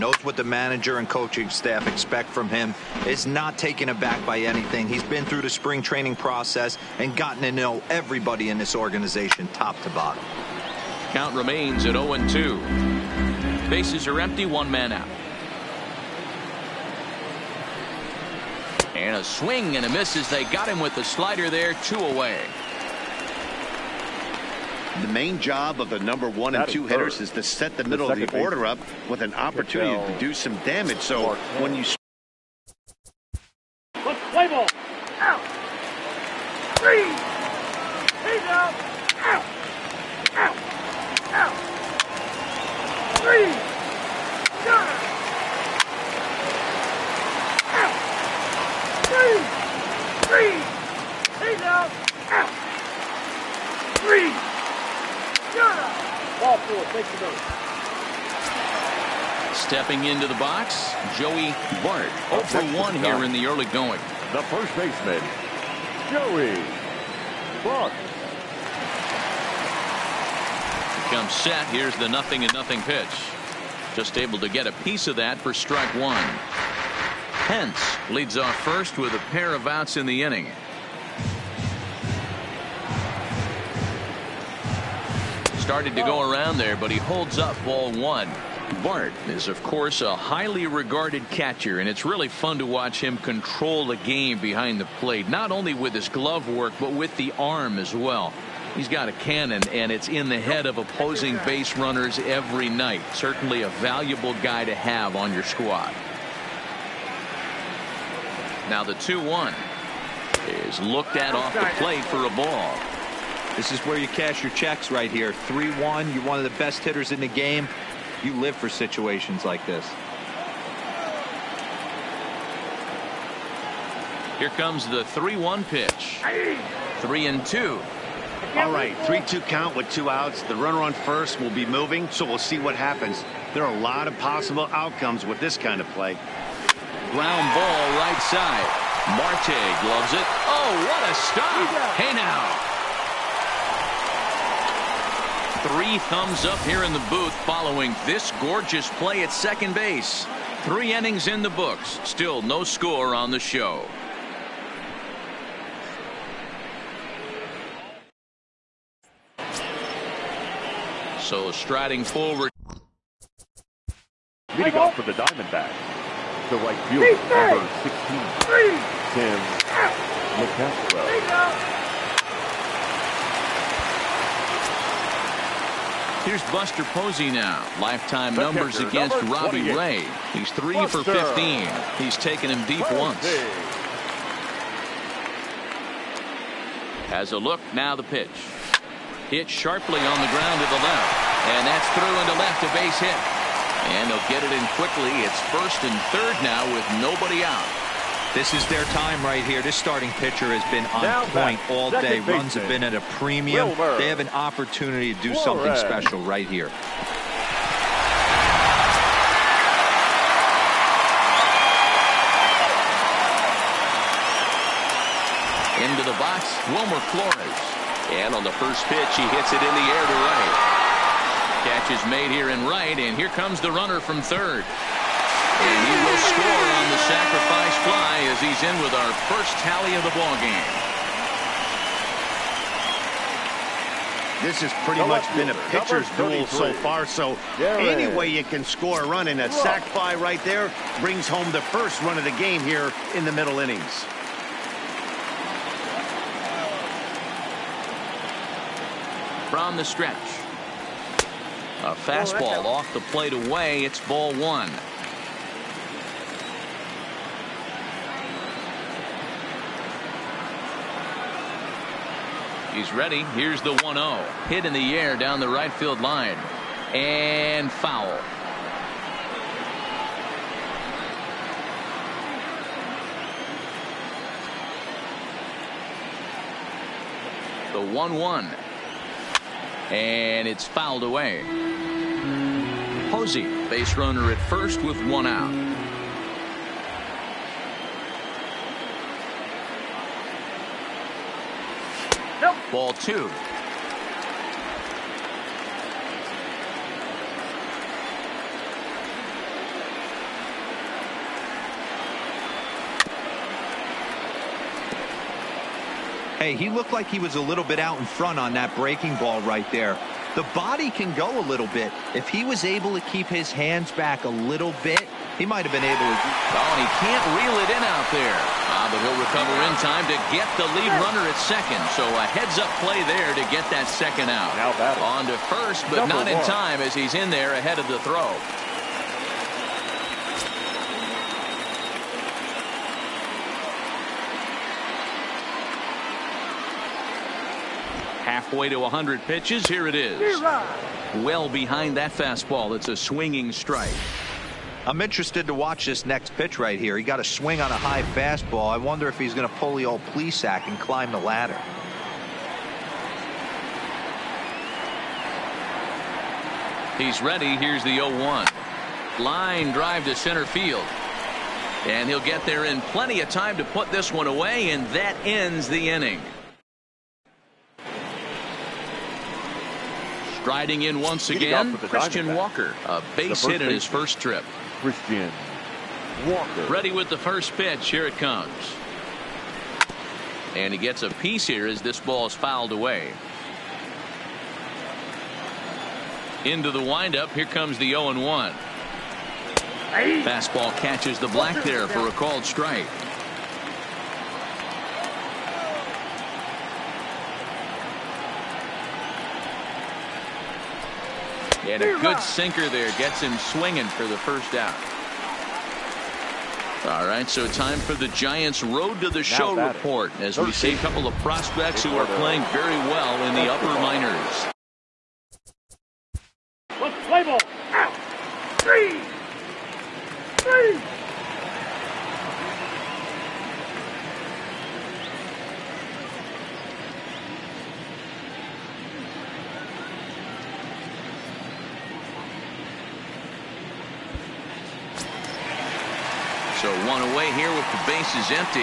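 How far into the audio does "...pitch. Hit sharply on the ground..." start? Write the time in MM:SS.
03:08.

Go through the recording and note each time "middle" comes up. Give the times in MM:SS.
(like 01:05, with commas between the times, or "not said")
00:27, 04:03.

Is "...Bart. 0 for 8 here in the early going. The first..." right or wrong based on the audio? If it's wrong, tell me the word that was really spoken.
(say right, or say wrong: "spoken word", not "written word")
wrong: "1", not "8".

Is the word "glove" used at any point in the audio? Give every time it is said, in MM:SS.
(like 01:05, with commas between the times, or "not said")
01:36, 02:19.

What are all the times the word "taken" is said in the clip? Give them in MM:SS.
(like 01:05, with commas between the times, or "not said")
00:03, 03:02.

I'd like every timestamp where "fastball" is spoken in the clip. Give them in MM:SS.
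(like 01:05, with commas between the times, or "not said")
04:12, 05:42, 05:48, 06:30.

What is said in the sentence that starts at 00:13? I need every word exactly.
Bases are empty, one man out.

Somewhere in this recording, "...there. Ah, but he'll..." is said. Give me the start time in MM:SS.
05:18.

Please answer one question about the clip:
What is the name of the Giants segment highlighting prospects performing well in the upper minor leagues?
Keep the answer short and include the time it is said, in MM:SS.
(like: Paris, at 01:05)
Road to the Show, at 06:48.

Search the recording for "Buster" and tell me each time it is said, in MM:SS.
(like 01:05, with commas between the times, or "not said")
02:56, 03:00.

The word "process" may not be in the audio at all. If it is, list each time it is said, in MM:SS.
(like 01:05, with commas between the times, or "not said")
00:06.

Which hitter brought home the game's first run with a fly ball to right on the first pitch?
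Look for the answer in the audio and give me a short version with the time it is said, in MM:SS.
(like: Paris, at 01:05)
Wilmer Flores, at 03:36.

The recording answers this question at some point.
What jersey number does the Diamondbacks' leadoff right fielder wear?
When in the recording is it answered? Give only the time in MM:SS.
02:47.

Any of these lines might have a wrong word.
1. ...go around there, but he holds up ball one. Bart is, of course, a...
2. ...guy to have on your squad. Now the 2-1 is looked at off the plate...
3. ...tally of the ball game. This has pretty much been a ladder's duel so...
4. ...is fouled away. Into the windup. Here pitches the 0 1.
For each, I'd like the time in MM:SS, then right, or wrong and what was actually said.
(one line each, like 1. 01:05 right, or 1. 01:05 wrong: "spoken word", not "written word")
1. 01:26 right
2. 01:44 right
3. 03:49 wrong: "pitcher", not "ladder"
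4. 06:22 wrong: "comes", not "pitches".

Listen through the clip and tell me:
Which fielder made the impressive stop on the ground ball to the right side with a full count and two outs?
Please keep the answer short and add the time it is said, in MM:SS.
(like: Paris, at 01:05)
Marte, at 02:19.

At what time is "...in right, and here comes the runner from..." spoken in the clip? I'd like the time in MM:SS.
03:42.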